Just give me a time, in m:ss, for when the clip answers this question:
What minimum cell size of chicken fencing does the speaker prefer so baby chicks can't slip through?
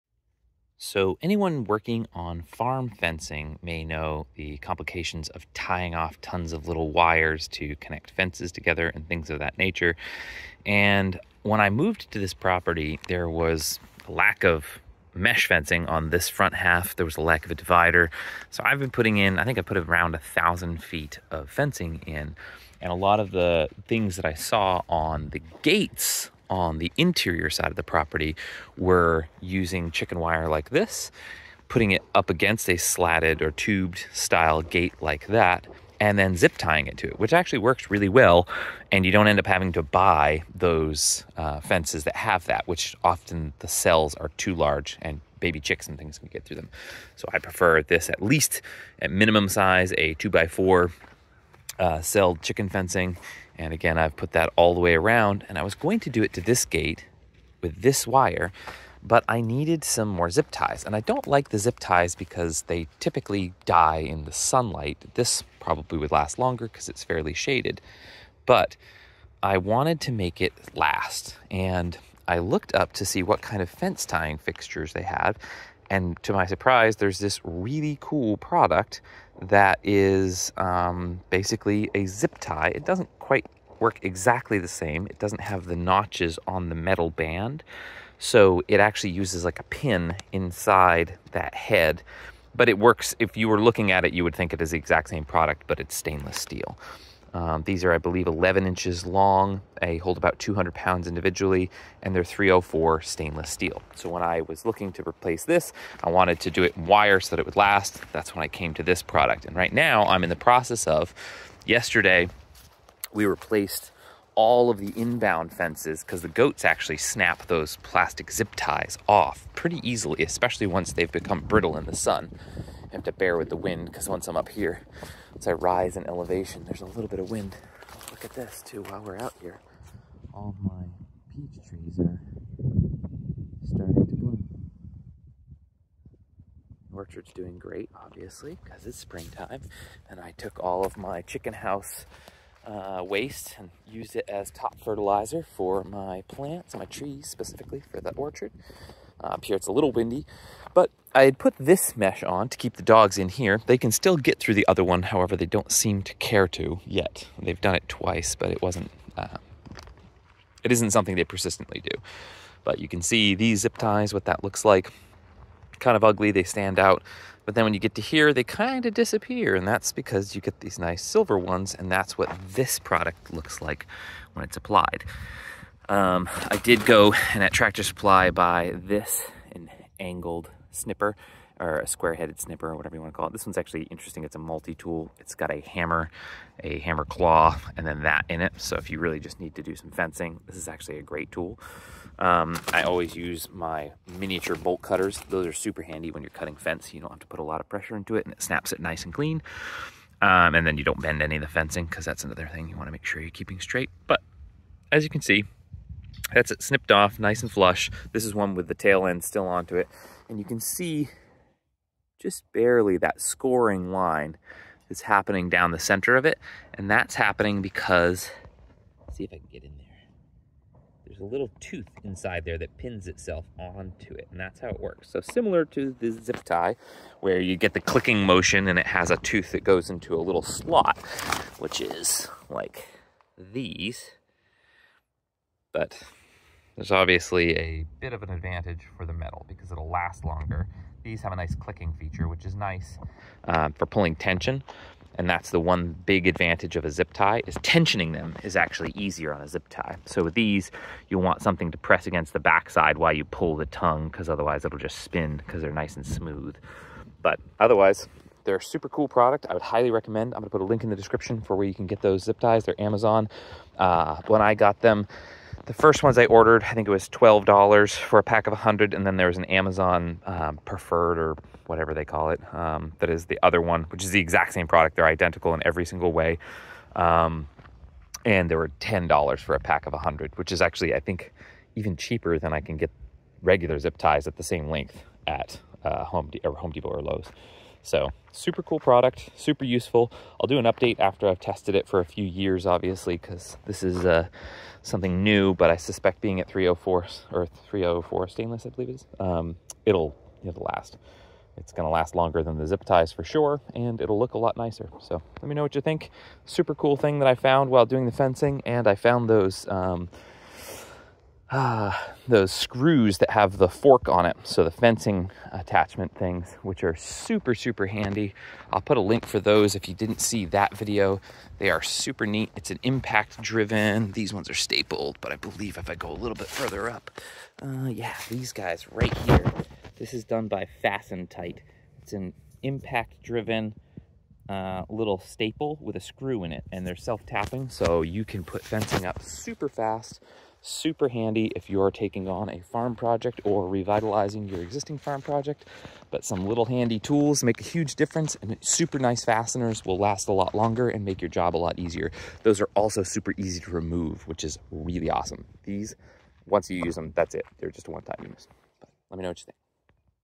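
0:50.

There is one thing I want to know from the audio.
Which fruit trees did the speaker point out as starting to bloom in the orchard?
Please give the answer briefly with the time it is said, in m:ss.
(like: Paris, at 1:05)
Peach trees, at 2:11.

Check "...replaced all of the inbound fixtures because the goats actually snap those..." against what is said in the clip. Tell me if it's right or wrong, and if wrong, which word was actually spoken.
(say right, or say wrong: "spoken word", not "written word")
wrong: "fences", not "fixtures".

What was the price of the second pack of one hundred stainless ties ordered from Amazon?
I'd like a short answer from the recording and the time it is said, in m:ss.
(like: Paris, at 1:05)
$10, at 4:38.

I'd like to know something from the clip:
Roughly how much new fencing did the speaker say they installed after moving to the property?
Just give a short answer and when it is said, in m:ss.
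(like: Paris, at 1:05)
1000 feet, at 0:20.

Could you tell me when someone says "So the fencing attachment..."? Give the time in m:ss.
5:14.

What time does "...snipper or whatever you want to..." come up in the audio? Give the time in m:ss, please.
3:02.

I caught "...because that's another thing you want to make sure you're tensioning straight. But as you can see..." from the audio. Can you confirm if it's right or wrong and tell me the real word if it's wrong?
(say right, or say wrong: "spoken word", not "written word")
wrong: "keeping", not "tensioning".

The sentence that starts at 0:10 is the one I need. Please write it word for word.
And when I moved to this property, there was a lack of mesh fencing on this front half.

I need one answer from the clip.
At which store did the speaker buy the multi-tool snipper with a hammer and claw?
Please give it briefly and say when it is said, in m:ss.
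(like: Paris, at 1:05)
Tractor Supply, at 2:57.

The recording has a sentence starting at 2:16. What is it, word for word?
orchard's doing great, obviously, because it's springtime.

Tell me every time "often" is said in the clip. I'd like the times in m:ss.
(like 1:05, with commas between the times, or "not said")
0:43.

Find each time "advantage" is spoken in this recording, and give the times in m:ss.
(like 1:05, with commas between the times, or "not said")
3:58, 4:06.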